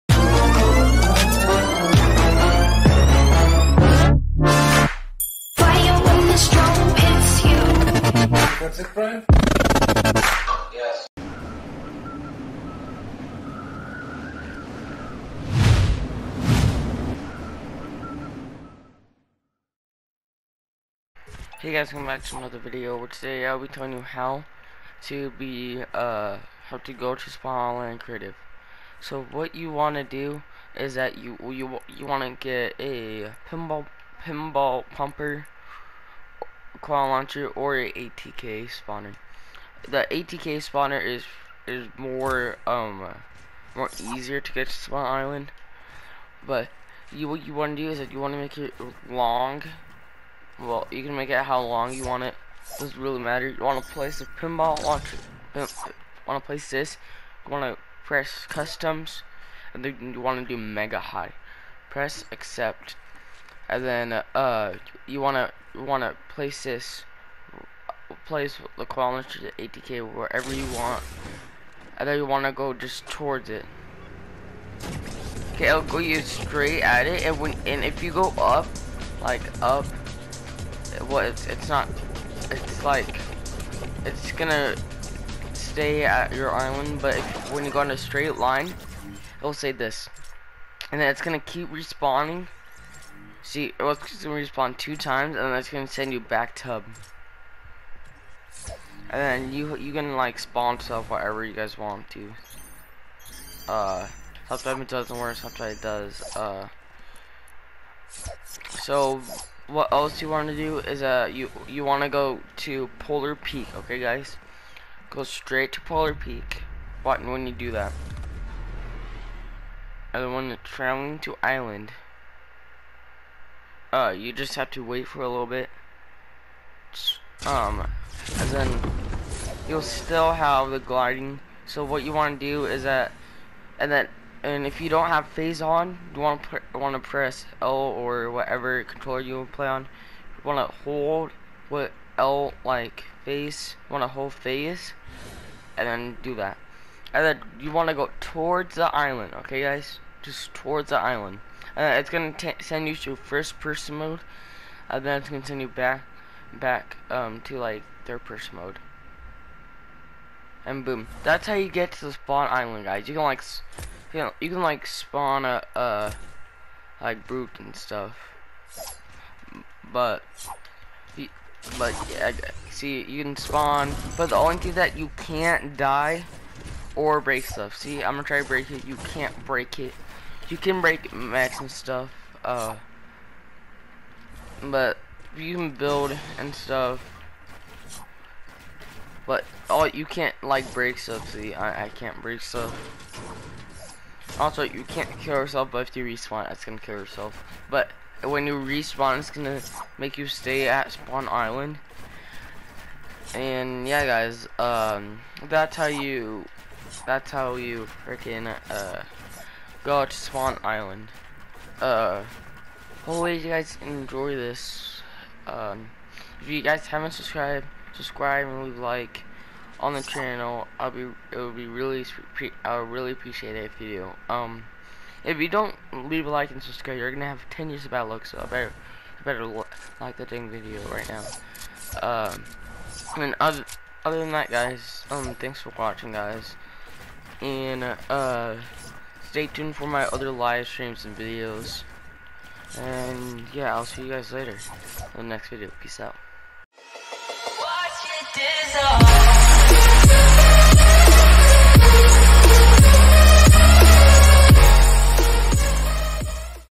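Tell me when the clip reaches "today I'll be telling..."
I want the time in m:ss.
0:23.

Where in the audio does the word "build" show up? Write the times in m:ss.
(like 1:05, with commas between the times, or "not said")
3:05.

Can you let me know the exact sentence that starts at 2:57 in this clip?
See, I'm gonna try to break it.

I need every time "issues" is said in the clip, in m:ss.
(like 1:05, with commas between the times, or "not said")
not said.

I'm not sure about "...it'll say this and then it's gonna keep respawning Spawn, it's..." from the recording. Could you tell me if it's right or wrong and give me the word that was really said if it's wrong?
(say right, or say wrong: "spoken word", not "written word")
wrong: "See", not "Spawn".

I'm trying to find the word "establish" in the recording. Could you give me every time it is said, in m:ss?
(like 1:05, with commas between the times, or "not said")
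not said.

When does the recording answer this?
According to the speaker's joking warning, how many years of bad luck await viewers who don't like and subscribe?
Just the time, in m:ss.
3:47.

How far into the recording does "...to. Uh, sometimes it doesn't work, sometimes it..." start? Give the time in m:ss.
1:42.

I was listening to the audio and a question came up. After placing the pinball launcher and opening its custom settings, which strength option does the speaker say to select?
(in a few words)
mega high.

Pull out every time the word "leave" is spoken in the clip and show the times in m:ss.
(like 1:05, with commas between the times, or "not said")
3:38, 3:45.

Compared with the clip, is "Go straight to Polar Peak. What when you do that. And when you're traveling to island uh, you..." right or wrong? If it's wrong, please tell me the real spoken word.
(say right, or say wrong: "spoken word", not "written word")
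right.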